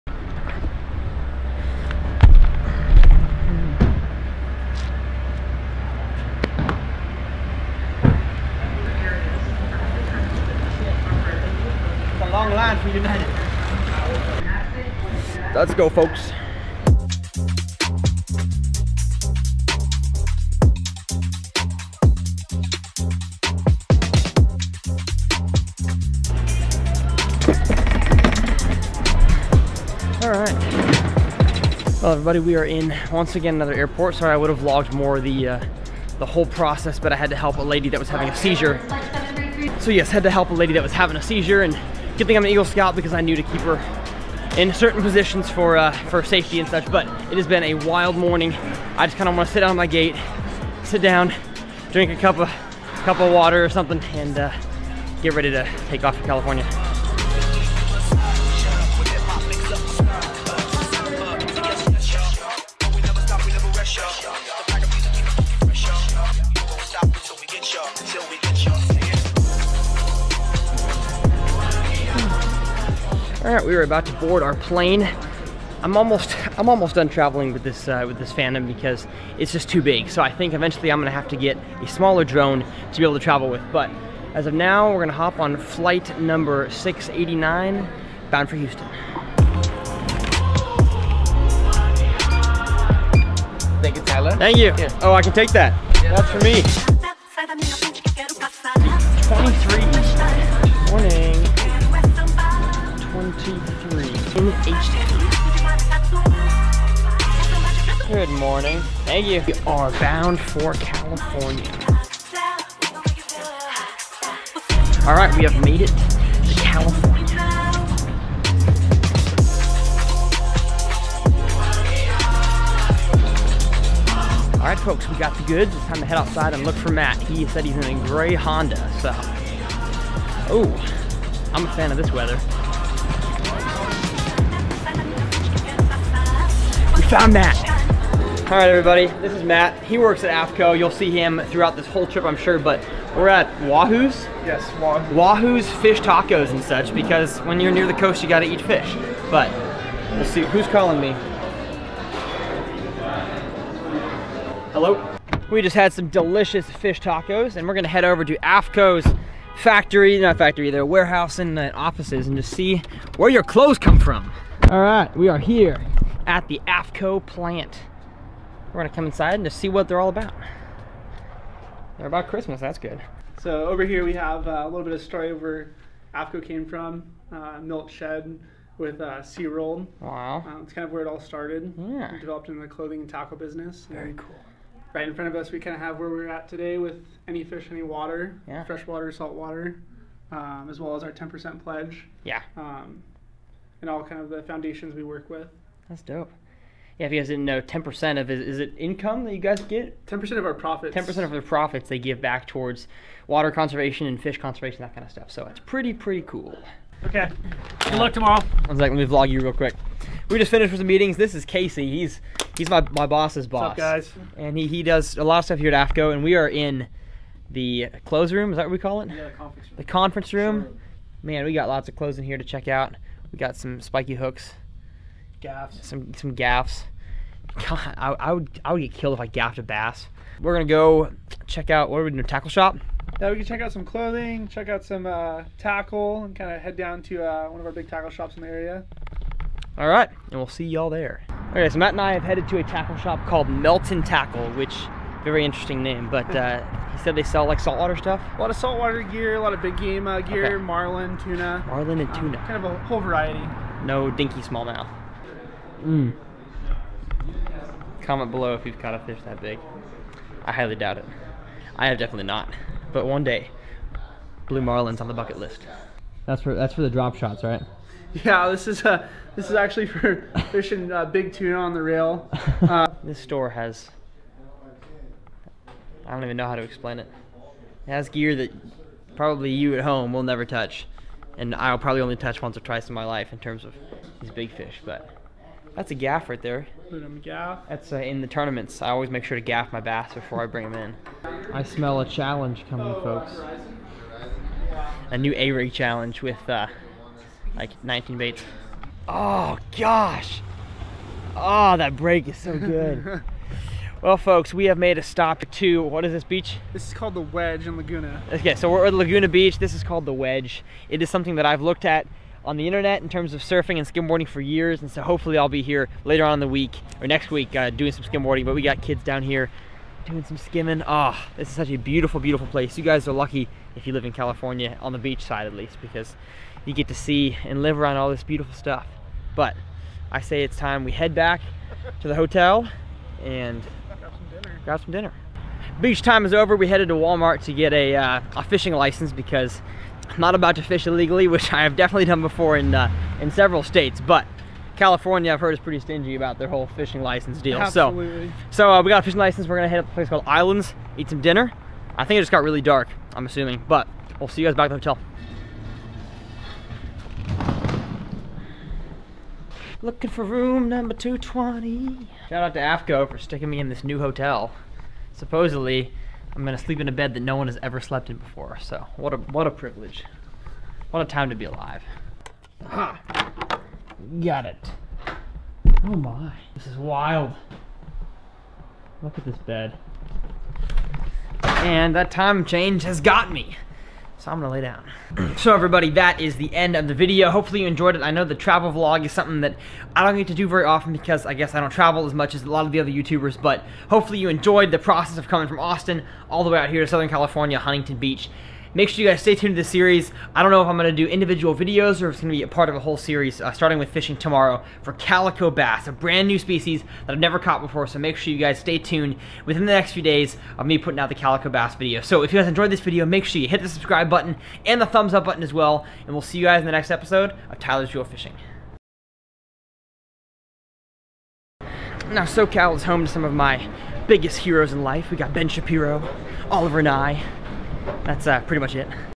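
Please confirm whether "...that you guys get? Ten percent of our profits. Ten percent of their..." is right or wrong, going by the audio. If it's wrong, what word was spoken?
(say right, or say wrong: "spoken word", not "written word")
right.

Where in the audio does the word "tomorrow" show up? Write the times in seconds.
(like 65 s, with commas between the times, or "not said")
208 s, 404 s.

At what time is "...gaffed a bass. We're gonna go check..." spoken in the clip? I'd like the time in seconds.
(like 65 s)
229 s.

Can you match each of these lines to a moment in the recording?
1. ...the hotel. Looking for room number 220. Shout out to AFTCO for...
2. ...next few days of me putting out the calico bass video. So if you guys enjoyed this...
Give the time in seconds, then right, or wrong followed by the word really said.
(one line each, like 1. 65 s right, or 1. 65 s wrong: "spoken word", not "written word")
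1. 354 s right
2. 409 s right.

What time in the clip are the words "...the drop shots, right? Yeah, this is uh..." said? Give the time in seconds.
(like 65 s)
266 s.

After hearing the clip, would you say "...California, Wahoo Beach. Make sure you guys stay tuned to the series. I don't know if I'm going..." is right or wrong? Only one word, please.
wrong.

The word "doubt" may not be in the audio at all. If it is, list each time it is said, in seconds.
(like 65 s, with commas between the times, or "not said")
260 s.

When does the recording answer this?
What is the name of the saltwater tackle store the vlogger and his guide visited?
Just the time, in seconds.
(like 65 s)
243 s.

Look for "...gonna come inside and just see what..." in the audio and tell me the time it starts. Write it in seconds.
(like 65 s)
168 s.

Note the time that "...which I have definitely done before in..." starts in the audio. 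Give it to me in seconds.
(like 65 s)
341 s.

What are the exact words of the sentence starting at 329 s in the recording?
But I say it's time we head back to the hotel and grab some dinner.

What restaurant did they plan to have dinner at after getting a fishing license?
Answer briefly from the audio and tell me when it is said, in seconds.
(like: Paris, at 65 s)
Islands, at 350 s.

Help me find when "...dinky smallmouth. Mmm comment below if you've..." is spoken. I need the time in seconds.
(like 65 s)
254 s.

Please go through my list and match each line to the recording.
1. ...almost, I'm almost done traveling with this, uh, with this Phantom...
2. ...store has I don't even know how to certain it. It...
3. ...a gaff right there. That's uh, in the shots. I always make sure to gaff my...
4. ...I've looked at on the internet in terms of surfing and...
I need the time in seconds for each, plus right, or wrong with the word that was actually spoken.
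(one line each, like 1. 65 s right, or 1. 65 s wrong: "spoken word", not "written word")
1. 75 s right
2. 273 s wrong: "explain", not "certain"
3. 285 s wrong: "tournaments", not "shots"
4. 311 s right.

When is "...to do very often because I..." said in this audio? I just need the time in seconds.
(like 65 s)
390 s.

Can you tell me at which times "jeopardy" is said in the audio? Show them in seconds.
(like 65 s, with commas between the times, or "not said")
not said.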